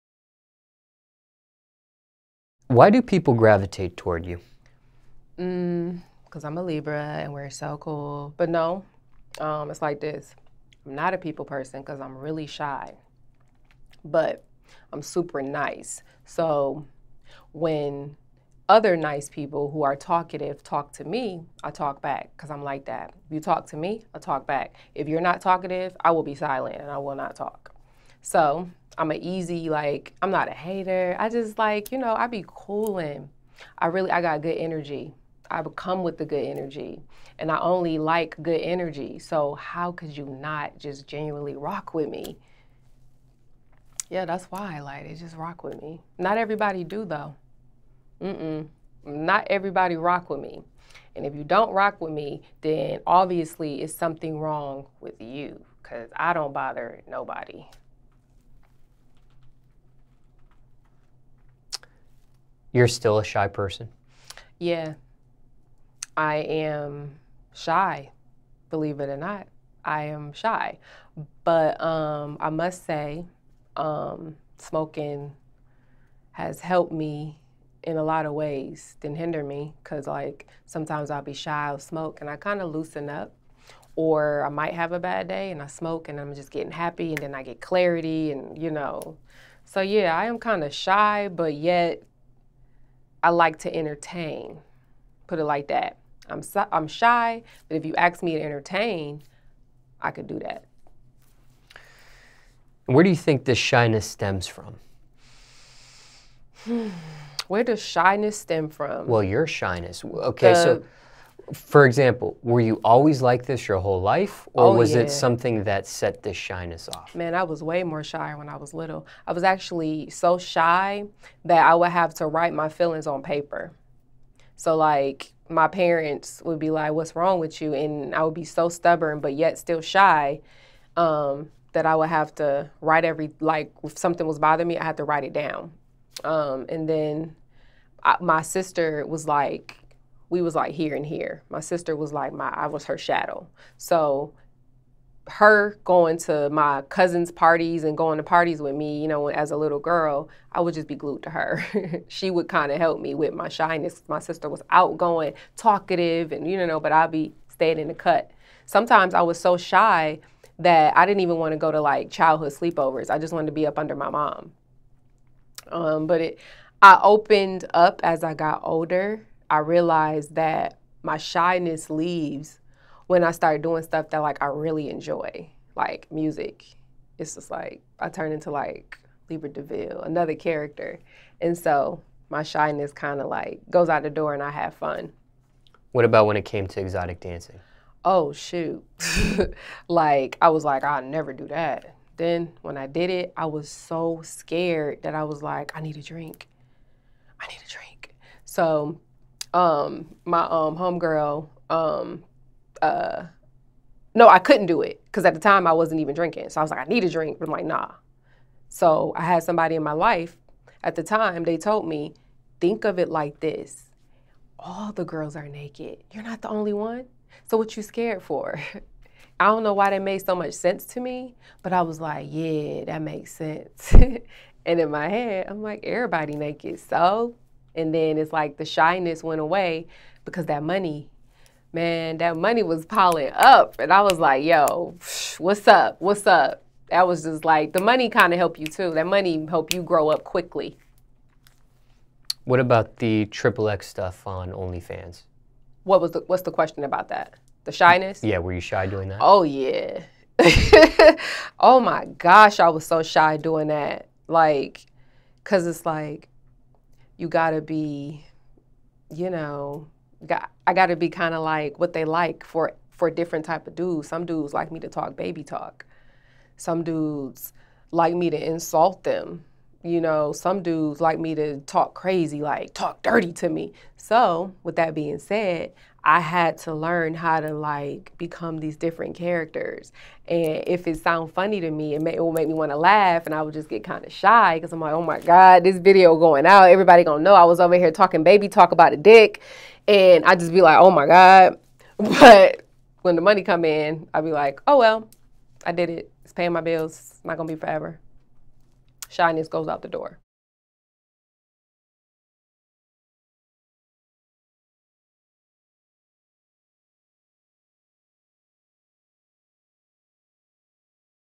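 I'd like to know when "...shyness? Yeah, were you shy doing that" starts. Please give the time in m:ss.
4:07.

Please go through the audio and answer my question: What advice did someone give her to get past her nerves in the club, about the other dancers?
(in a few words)
all the girls are naked.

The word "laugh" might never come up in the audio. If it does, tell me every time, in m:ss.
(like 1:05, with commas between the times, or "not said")
4:42.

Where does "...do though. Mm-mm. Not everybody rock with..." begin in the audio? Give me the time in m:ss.
0:46.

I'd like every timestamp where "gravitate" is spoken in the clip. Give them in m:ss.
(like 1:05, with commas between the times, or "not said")
0:03.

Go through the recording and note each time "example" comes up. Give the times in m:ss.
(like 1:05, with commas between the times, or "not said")
1:51.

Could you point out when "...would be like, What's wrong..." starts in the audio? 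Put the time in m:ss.
2:06.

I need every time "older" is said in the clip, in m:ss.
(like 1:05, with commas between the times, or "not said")
2:48.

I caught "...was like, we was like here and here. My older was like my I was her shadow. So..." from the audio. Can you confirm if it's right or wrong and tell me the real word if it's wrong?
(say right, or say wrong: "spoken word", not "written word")
wrong: "sister", not "older".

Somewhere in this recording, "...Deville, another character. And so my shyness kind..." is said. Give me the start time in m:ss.
2:59.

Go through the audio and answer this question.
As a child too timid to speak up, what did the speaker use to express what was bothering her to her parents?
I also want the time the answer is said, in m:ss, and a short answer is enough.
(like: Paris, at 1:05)
paper, at 2:03.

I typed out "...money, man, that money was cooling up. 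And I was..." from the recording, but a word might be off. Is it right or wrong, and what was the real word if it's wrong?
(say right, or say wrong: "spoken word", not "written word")
wrong: "piling", not "cooling".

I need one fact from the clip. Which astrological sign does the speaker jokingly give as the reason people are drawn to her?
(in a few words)
Libra.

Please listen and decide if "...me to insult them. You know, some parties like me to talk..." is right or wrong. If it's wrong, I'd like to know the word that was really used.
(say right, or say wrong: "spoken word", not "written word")
wrong: "dudes", not "parties".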